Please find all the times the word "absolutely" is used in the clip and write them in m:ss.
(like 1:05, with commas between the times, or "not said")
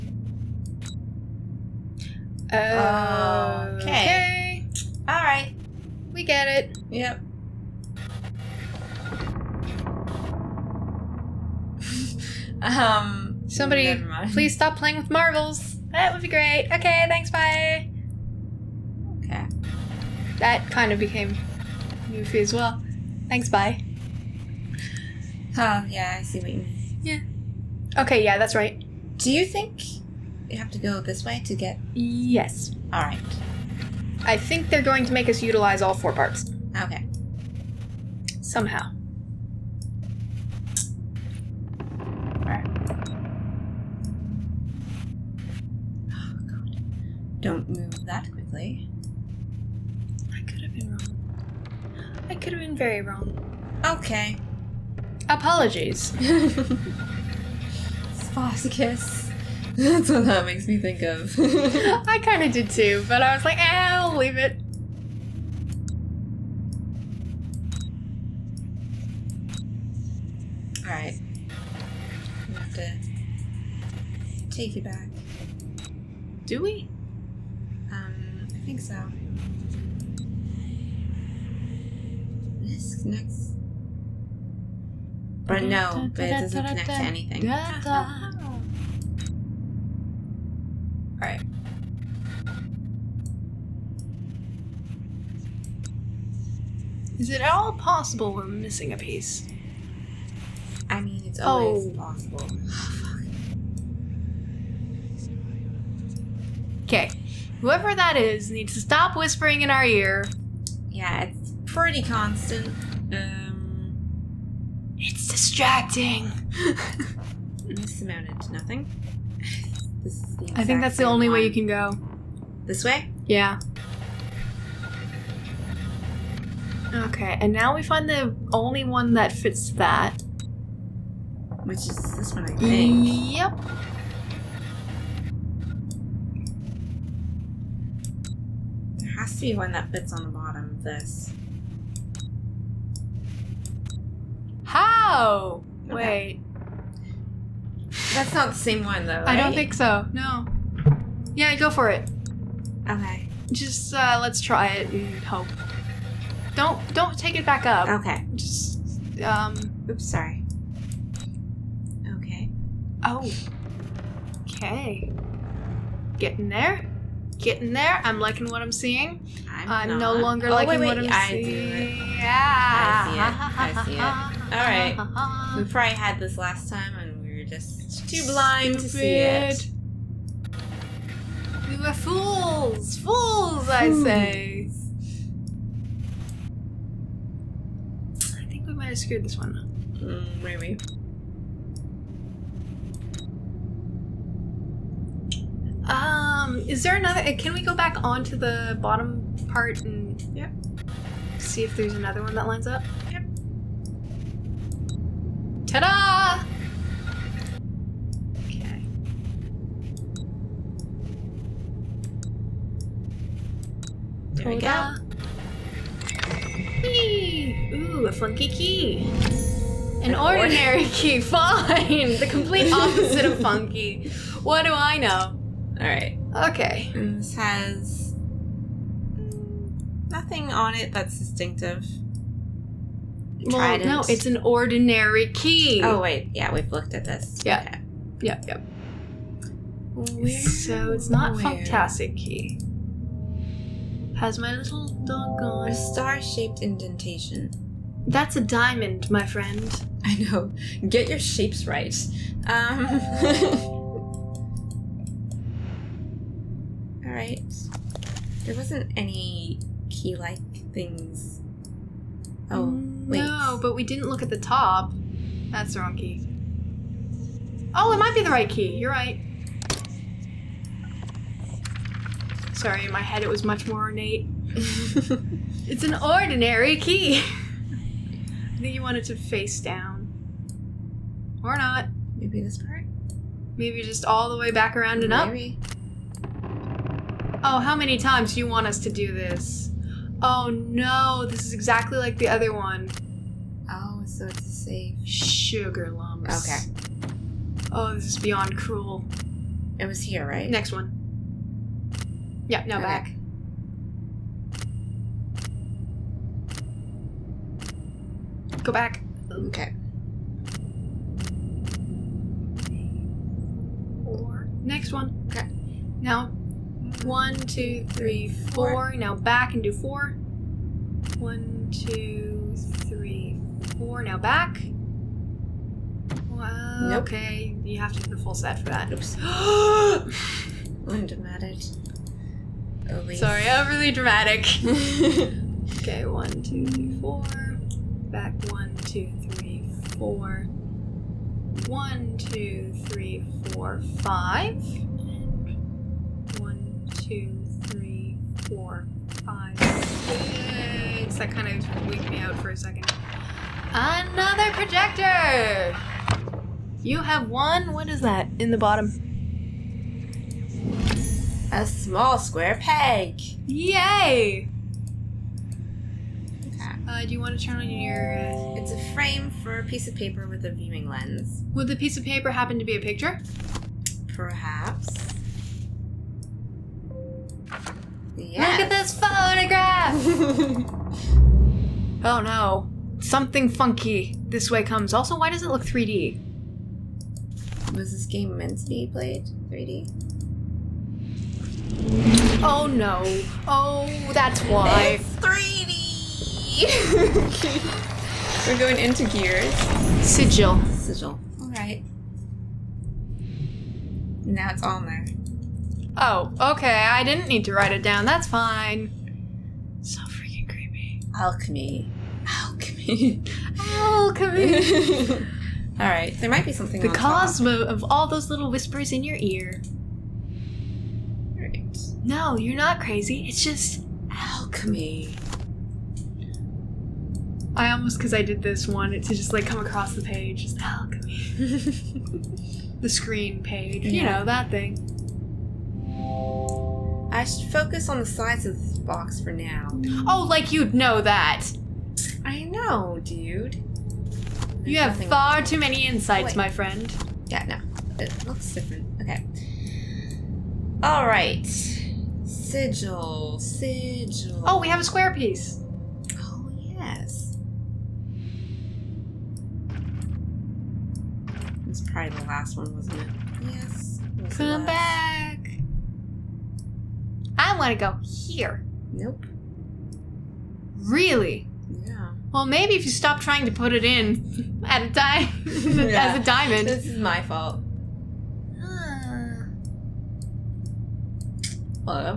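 not said.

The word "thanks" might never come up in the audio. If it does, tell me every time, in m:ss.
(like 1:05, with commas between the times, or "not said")
0:17, 0:23.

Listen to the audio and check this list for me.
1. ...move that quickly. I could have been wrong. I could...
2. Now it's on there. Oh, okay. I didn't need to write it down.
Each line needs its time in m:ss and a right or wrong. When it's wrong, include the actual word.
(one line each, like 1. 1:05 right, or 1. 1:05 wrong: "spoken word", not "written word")
1. 0:47 right
2. 6:44 right.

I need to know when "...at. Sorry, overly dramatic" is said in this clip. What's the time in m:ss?
5:31.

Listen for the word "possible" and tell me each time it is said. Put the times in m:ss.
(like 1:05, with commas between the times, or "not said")
1:37, 1:41.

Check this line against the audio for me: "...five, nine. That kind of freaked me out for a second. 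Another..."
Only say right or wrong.
wrong.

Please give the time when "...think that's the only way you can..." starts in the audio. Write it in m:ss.
2:00.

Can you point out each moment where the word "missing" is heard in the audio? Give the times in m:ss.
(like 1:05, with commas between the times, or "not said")
1:38.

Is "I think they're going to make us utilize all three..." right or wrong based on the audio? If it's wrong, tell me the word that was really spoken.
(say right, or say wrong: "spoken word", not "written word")
wrong: "four", not "three".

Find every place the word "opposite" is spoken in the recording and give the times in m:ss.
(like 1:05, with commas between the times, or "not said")
3:42.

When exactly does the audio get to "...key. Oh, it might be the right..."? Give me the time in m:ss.
4:25.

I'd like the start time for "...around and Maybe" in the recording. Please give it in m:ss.
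4:44.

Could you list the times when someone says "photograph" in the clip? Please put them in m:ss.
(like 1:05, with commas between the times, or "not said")
6:18.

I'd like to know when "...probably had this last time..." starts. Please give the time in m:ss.
2:55.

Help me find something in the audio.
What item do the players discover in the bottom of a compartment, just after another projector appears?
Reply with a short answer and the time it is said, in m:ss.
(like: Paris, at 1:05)
small square peg, at 6:01.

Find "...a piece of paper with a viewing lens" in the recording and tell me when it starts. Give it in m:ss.
6:09.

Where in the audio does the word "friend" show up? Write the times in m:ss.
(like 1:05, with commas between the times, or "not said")
4:09, 7:26.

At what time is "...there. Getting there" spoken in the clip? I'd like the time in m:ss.
2:46.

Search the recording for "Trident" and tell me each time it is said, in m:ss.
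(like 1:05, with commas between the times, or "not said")
3:53.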